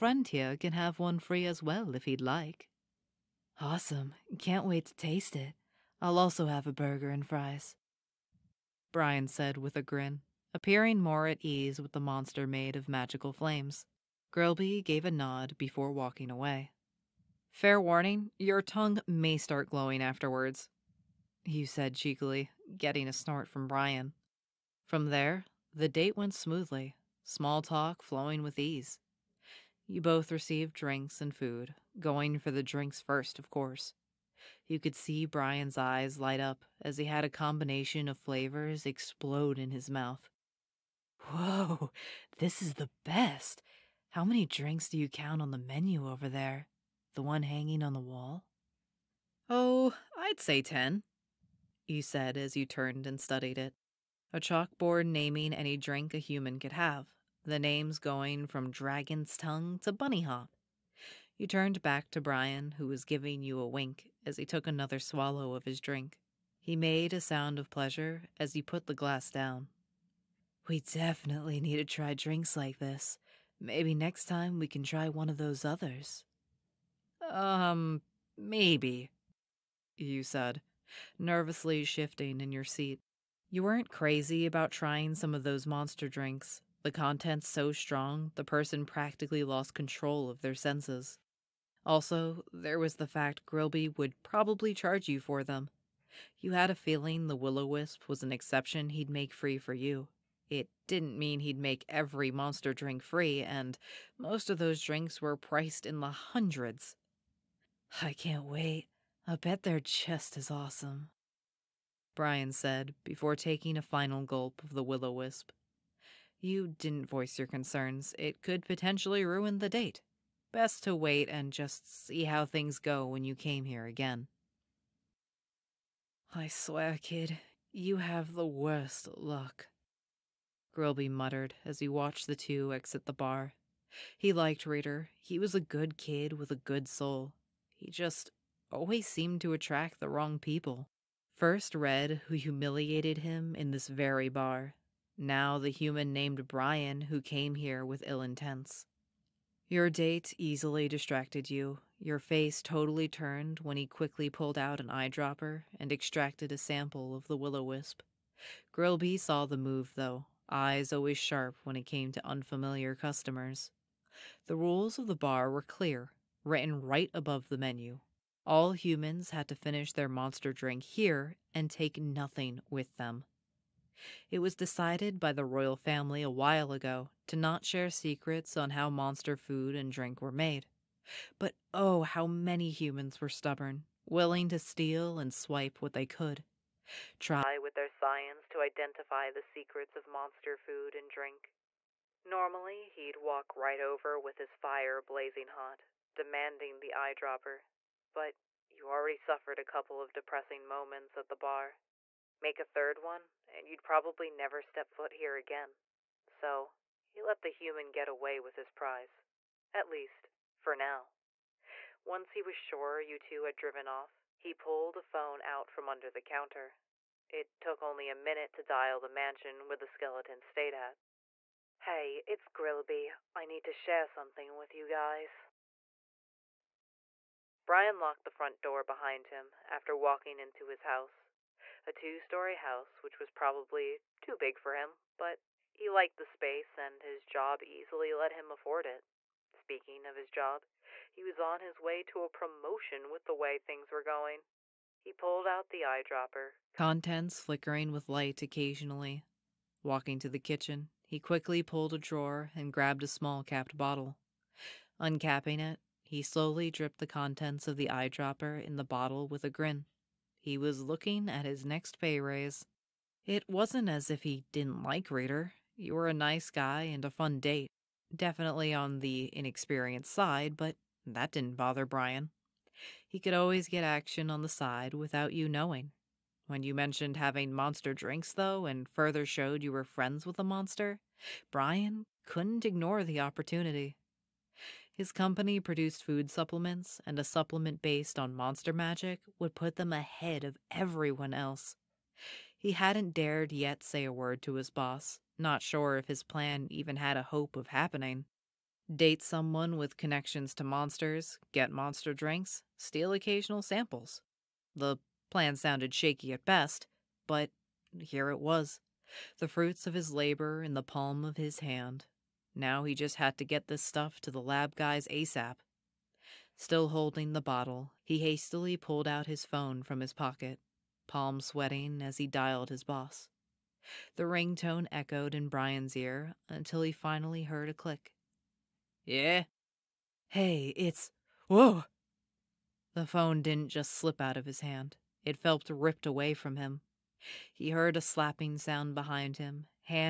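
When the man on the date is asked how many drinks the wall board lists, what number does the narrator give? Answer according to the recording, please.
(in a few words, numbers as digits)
10.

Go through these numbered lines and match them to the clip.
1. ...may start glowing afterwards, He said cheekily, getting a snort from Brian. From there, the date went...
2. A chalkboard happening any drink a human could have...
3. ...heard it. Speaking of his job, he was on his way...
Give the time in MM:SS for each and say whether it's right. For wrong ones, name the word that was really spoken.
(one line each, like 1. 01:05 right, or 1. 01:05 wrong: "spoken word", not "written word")
1. 00:19 right
2. 00:54 wrong: "naming", not "happening"
3. 03:58 wrong: "afford", not "heard".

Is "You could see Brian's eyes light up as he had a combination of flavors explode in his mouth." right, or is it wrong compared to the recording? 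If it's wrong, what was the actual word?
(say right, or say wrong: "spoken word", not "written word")
right.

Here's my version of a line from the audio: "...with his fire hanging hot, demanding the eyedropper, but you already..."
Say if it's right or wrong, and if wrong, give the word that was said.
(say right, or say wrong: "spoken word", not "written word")
wrong: "blazing", not "hanging".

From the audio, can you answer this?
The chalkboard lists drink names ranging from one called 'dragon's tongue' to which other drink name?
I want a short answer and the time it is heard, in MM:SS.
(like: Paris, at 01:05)
bunny hop, at 00:59.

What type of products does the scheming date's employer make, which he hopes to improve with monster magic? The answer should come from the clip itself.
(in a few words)
food supplements.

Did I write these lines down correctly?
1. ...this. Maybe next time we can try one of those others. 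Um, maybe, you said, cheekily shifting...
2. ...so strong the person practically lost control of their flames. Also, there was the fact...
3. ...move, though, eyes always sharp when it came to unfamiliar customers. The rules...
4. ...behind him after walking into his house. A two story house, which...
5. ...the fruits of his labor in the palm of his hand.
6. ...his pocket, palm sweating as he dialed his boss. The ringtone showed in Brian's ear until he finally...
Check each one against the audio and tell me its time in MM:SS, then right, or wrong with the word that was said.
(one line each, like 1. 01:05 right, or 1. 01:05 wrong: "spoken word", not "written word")
1. 01:12 wrong: "nervously", not "cheekily"
2. 01:27 wrong: "senses", not "flames"
3. 02:39 right
4. 03:48 right
5. 05:09 right
6. 05:19 wrong: "echoed", not "showed".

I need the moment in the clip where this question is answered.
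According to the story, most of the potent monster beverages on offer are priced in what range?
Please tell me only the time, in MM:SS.
01:45.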